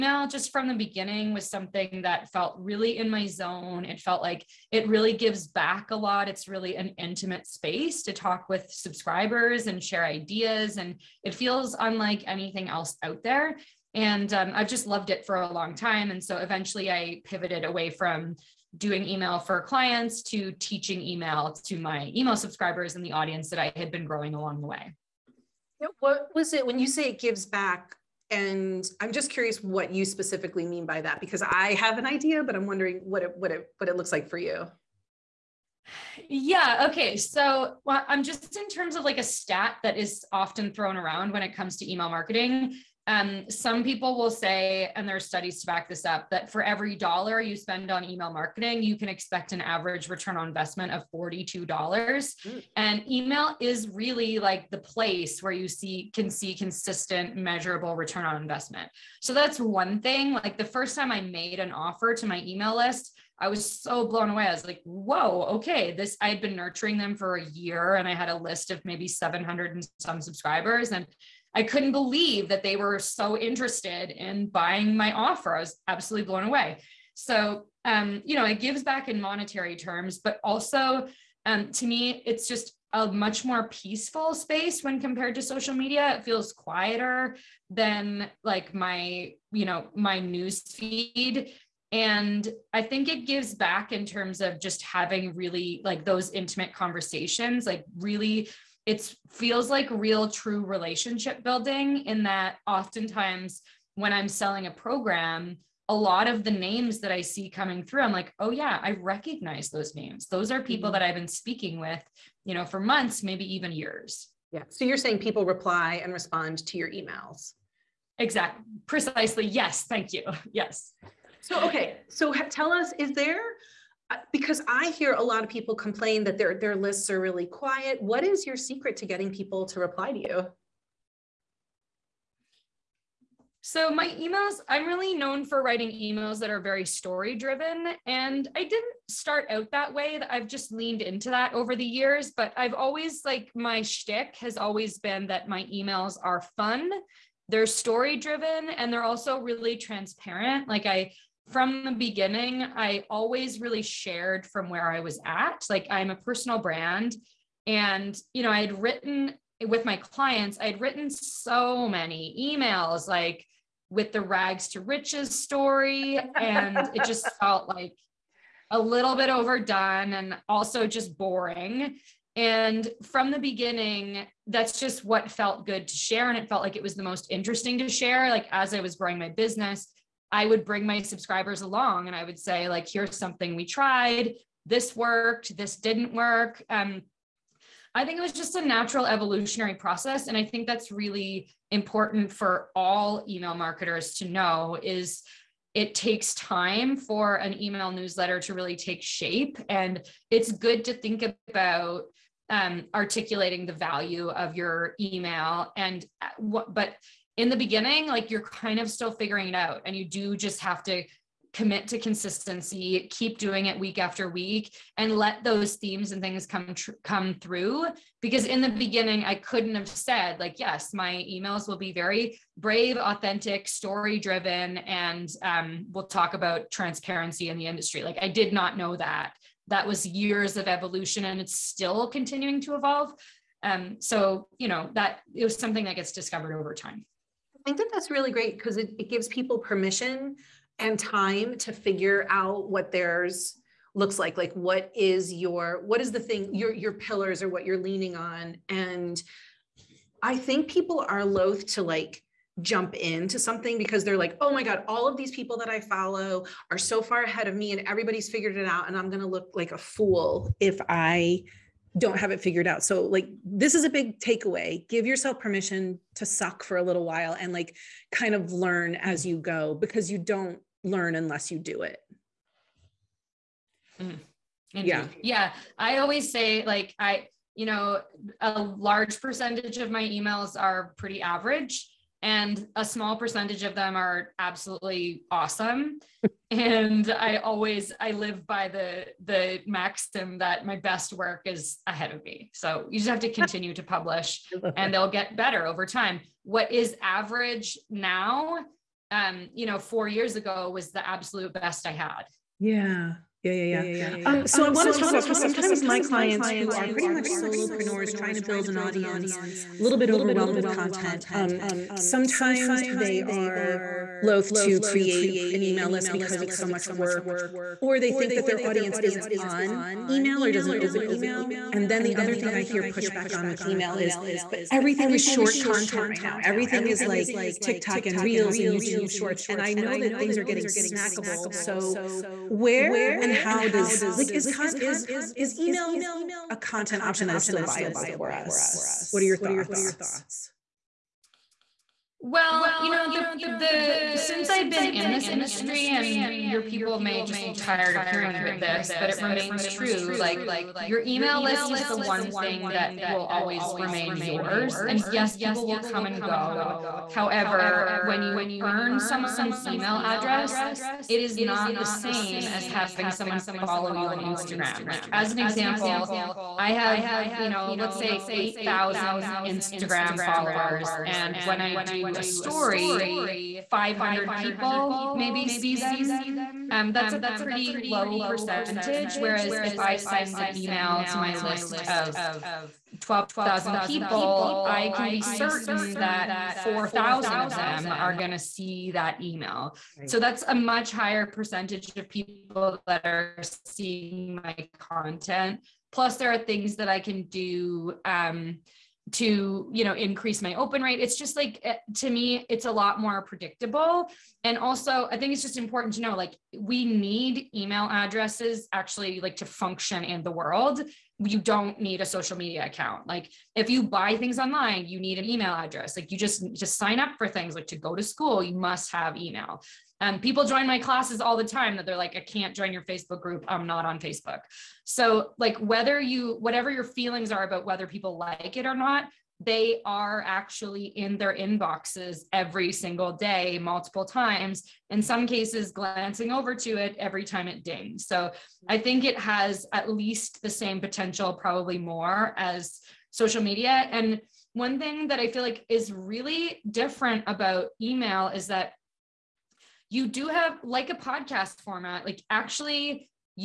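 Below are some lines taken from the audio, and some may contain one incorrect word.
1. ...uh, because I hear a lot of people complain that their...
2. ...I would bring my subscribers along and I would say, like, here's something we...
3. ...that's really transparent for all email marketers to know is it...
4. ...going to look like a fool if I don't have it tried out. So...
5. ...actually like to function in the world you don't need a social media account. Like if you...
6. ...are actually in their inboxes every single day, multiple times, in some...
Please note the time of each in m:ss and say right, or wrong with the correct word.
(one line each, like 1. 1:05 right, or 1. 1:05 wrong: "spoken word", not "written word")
1. 2:04 right
2. 3:00 right
3. 3:10 wrong: "important", not "transparent"
4. 4:19 wrong: "figured", not "tried"
5. 6:48 right
6. 7:09 right.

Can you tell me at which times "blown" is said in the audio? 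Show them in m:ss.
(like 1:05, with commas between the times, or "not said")
1:04, 1:16.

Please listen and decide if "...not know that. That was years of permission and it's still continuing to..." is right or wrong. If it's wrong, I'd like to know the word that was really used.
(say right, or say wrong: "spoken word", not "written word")
wrong: "evolution", not "permission".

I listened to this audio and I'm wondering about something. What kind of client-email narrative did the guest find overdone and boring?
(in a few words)
rags to riches story.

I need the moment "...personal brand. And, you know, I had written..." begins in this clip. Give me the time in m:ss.
2:36.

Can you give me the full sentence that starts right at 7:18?
So I think it has at least the same potential, probably more, as social media.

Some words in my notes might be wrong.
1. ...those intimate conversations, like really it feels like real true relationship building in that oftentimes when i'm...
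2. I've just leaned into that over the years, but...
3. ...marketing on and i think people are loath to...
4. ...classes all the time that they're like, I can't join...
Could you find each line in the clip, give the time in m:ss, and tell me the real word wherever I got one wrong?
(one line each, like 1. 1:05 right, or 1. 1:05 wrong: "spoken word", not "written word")
1. 1:36 right
2. 2:20 right
3. 4:07 wrong: "leaning", not "marketing"
4. 7:00 right.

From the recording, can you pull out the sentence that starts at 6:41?
It's just like, eh, to me, it's a lot more predictable.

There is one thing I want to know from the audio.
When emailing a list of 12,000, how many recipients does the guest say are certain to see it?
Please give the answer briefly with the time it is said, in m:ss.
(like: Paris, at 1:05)
4,000, at 6:26.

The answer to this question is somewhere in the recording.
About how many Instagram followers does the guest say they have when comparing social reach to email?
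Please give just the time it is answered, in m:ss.
6:08.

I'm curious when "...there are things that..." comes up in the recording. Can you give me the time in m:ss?
6:36.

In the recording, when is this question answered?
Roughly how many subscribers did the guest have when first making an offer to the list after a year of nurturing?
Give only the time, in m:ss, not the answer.
1:09.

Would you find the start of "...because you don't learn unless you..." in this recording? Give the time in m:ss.
4:29.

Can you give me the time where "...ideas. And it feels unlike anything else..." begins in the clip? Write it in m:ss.
0:10.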